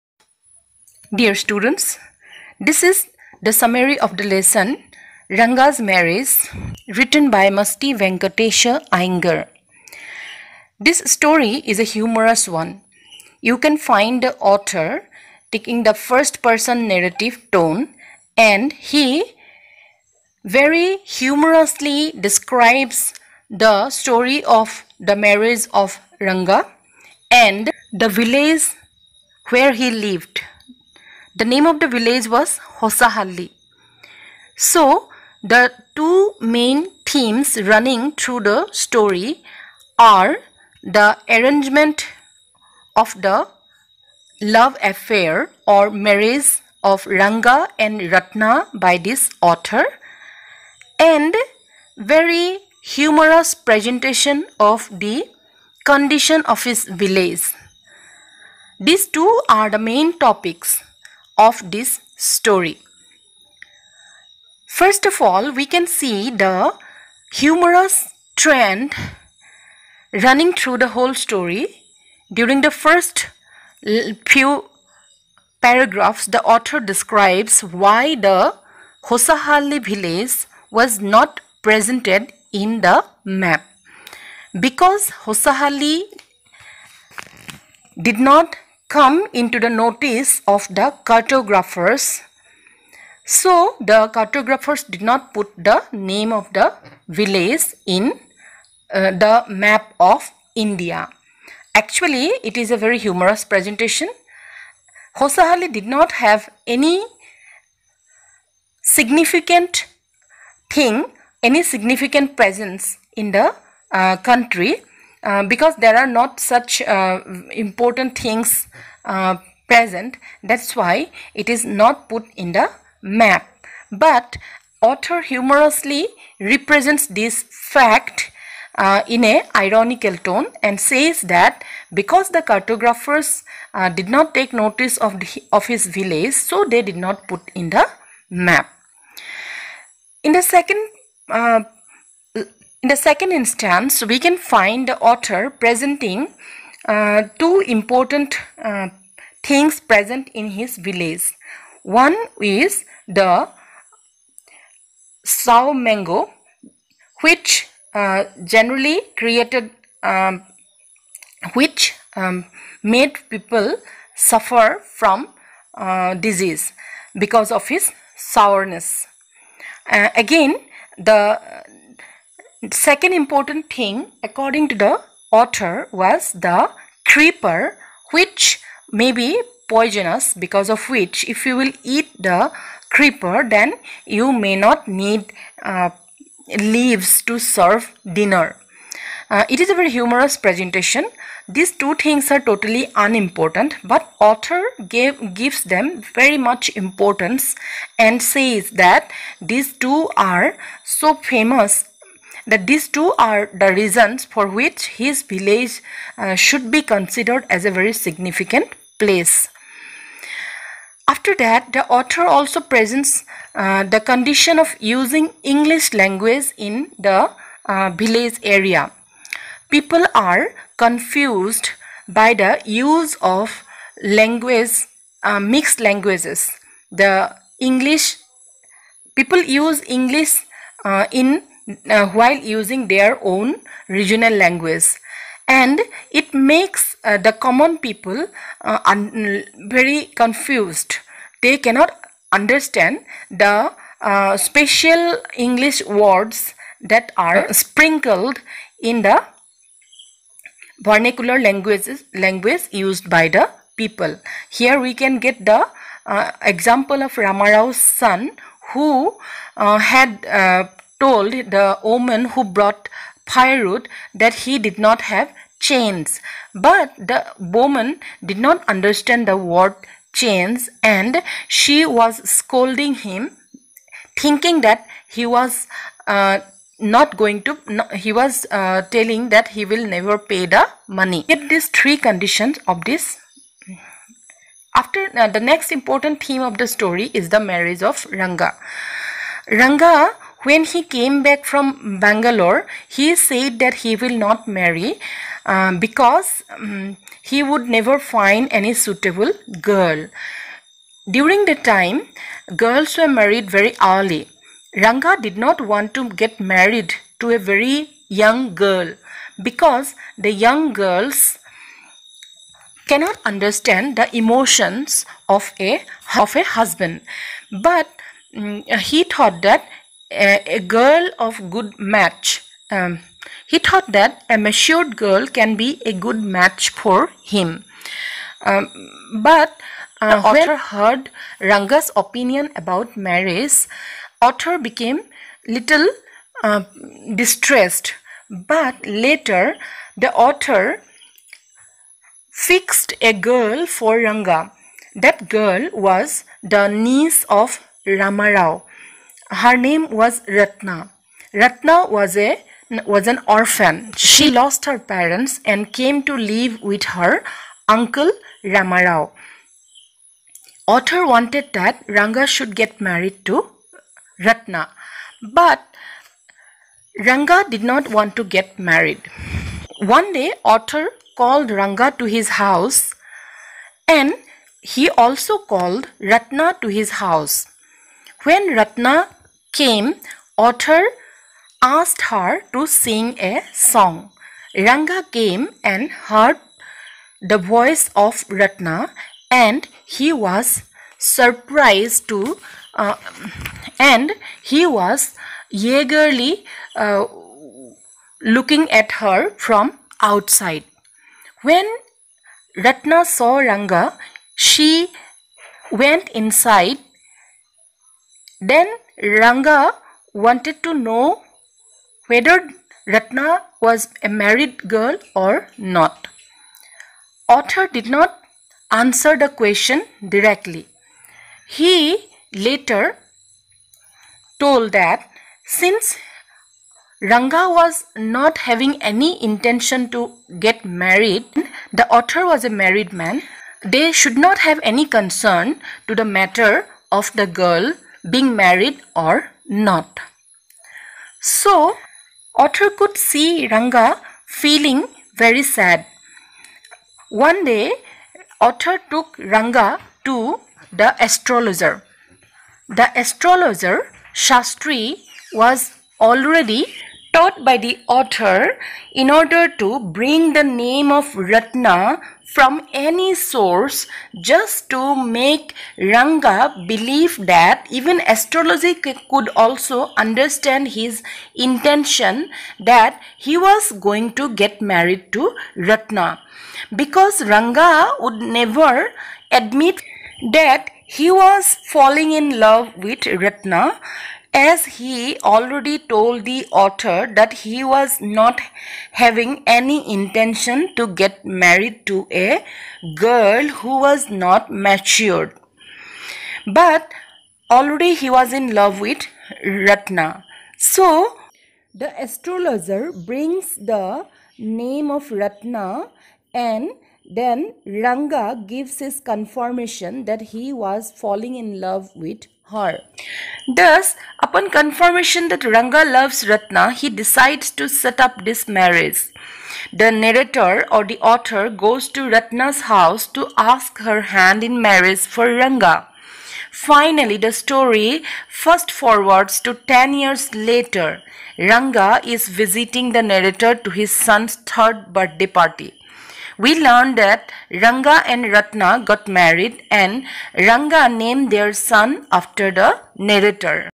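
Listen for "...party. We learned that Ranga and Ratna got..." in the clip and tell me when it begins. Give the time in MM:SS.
08:55.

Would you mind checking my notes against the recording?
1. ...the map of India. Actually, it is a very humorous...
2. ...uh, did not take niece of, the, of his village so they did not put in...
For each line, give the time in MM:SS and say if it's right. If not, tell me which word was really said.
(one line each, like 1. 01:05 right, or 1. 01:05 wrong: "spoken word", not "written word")
1. 01:39 right
2. 02:13 wrong: "notice", not "niece".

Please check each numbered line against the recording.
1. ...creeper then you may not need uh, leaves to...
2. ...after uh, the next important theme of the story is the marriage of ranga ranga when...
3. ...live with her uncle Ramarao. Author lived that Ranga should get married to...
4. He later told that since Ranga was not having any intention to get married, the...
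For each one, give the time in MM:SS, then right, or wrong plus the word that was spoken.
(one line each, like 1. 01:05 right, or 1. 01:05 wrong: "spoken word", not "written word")
1. 03:02 right
2. 04:44 right
3. 05:56 wrong: "wanted", not "lived"
4. 07:01 right.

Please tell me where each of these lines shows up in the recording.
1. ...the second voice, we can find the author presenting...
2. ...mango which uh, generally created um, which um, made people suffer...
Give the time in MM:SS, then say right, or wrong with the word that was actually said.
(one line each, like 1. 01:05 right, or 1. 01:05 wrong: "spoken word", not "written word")
1. 02:22 wrong: "instance", not "voice"
2. 02:35 right.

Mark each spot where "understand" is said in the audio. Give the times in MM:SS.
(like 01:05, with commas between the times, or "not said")
04:02, 04:28, 05:13, 07:49.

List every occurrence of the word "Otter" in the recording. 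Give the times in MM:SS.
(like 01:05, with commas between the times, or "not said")
07:22, 07:28.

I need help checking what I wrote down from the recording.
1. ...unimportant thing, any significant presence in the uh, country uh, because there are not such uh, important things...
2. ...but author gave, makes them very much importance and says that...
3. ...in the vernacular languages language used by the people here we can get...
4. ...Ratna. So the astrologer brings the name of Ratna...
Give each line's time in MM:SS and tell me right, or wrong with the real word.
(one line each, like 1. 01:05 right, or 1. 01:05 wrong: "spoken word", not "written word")
1. 01:48 wrong: "significant", not "unimportant"
2. 03:13 wrong: "gives", not "makes"
3. 04:08 right
4. 08:19 right.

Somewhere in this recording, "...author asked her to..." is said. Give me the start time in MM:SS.
06:20.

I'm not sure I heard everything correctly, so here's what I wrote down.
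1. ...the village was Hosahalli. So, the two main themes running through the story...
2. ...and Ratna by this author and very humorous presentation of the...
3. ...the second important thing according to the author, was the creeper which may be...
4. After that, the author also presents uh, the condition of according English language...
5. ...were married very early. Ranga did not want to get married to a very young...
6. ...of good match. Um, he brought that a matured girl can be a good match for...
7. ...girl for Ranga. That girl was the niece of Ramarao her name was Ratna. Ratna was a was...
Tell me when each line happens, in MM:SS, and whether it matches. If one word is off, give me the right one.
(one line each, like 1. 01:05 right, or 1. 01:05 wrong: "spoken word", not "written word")
1. 00:31 right
2. 00:47 right
3. 02:50 right
4. 03:31 wrong: "using", not "according"
5. 05:02 right
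6. 05:21 wrong: "thought", not "brought"
7. 05:43 right.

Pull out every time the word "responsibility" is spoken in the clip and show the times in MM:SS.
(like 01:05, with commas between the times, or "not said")
not said.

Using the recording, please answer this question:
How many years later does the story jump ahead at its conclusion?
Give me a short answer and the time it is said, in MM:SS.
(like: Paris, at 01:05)
10, at 08:49.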